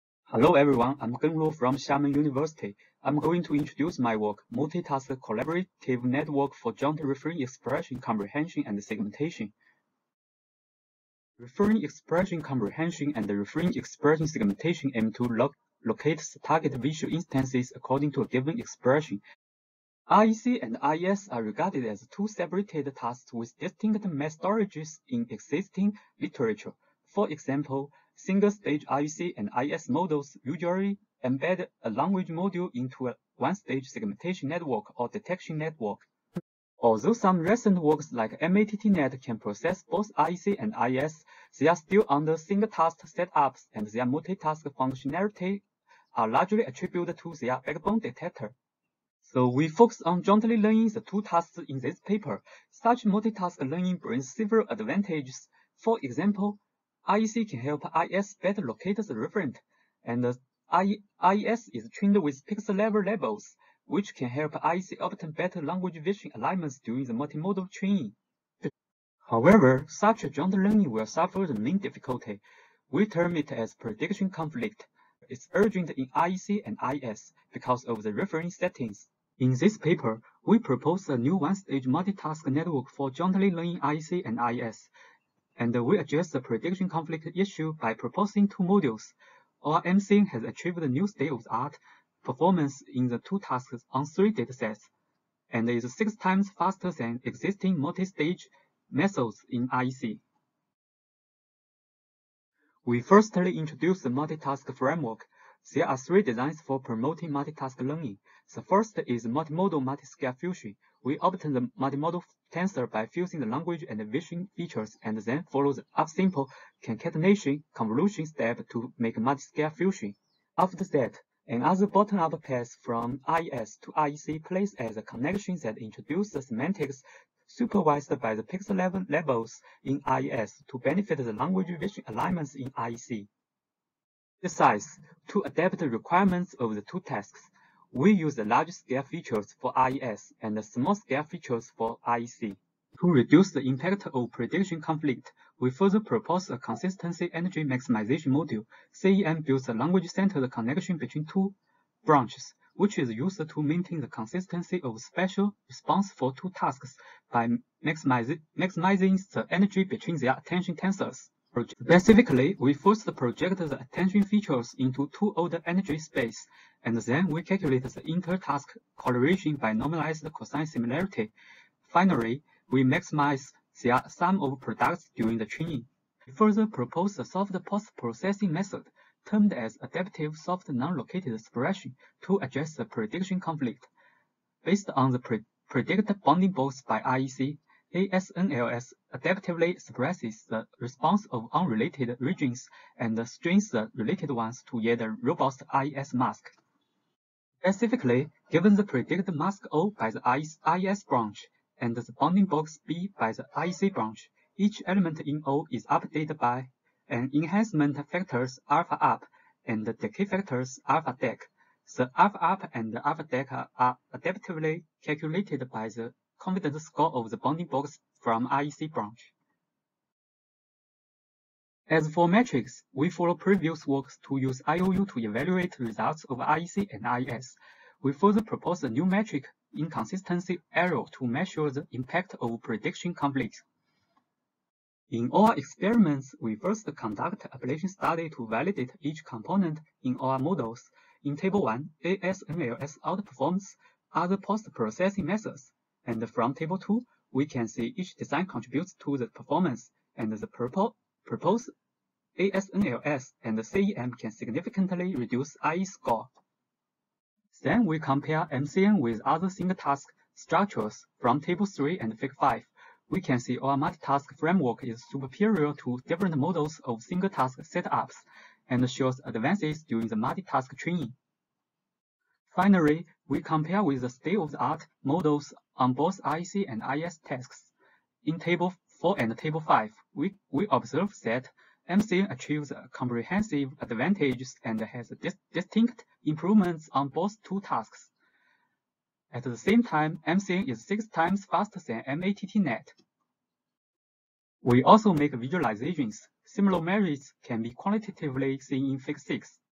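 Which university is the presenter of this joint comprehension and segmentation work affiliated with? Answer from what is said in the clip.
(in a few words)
Xiamen University.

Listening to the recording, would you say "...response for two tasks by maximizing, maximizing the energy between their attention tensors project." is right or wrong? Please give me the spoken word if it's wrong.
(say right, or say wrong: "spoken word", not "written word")
right.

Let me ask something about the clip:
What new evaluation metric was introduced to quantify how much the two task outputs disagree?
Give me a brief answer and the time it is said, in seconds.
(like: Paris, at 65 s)
inconsistency error, at 229 s.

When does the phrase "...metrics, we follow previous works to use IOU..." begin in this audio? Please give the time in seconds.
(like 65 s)
222 s.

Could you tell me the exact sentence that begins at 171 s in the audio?
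Finally, we maximize the sum of products during the training.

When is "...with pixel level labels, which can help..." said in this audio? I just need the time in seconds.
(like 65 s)
62 s.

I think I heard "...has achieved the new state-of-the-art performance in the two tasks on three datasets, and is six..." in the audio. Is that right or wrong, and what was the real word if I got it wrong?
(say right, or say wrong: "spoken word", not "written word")
right.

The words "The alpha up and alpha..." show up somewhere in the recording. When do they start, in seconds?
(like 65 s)
211 s.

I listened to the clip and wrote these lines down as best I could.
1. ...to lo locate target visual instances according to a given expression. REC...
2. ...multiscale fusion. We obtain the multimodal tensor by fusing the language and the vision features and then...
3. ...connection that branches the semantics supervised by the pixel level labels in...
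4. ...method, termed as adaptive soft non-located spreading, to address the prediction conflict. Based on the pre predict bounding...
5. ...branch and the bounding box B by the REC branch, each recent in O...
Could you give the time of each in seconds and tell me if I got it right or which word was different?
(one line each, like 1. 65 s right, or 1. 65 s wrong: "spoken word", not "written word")
1. 15 s right
2. 109 s right
3. 125 s wrong: "introduces", not "branches"
4. 178 s right
5. 201 s wrong: "element", not "recent".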